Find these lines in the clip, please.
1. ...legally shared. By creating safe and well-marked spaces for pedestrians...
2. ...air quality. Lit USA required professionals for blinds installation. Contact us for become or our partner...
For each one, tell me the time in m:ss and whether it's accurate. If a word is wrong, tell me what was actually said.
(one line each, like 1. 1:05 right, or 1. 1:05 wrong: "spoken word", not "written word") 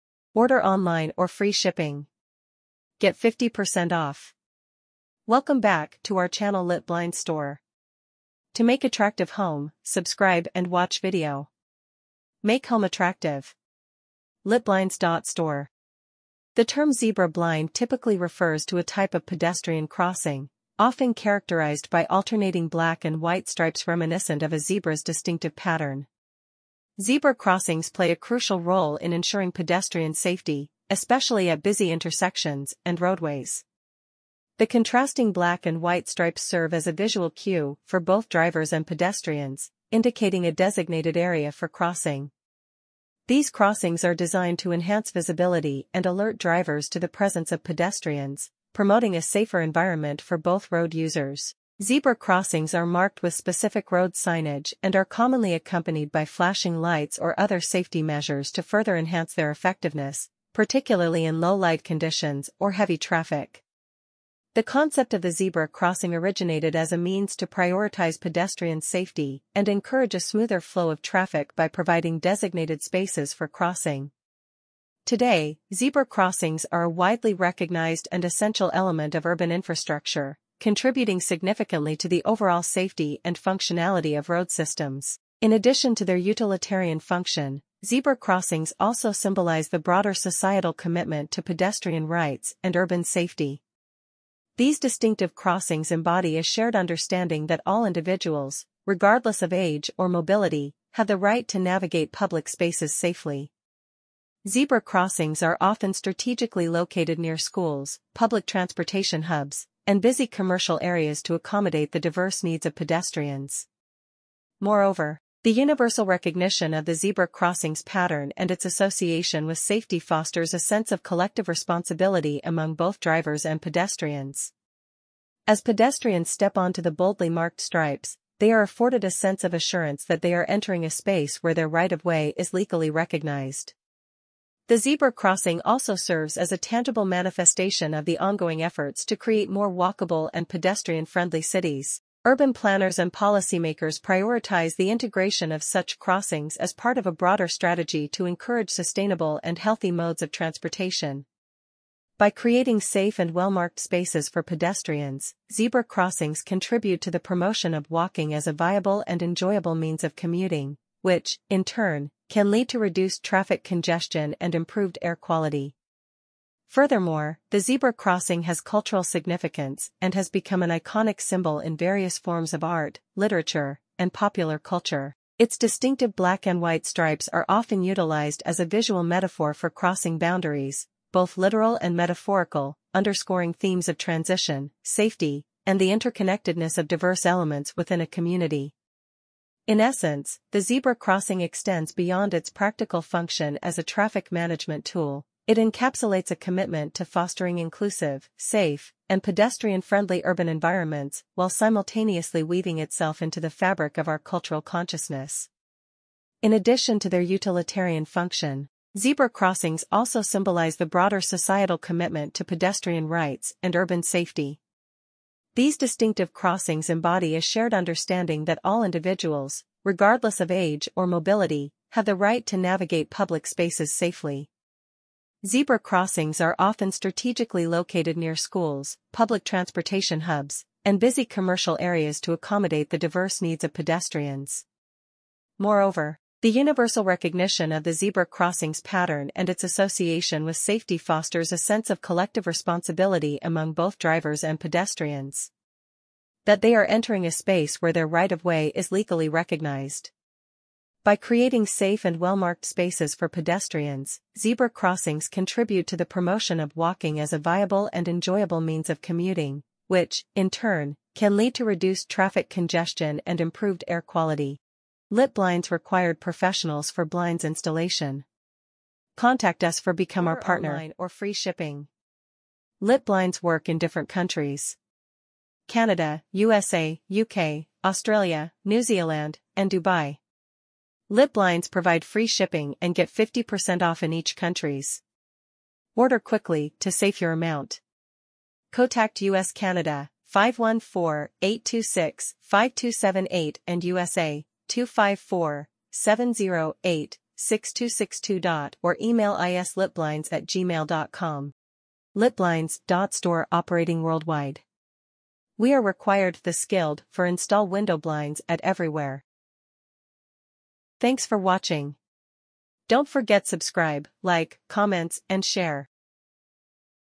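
1. 4:08 wrong: "recognized", not "shared"
2. 4:23 wrong: "Blinds", not "USA".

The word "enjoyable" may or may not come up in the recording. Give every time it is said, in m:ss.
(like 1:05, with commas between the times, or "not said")
2:39, 4:18.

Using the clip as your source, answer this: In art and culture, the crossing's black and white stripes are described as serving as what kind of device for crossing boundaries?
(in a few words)
visual metaphor.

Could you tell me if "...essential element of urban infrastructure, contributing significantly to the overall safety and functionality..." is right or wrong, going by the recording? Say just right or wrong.
right.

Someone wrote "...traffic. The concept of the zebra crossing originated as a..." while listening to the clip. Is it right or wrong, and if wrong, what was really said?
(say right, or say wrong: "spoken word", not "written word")
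right.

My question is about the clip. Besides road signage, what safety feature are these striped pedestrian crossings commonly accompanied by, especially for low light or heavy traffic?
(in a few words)
flashing lights.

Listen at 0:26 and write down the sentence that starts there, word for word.
Zebra crossings play a crucial role in ensuring pedestrian safety, especially at busy intersections and roadways.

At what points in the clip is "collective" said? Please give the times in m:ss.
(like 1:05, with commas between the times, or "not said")
2:01, 4:02.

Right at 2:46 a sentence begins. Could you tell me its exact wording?
Furthermore, the zebra crossing has cultural significance and has become an iconic symbol in various forms of art, literature, and popular culture.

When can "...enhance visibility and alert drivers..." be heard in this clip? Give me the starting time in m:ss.
0:44.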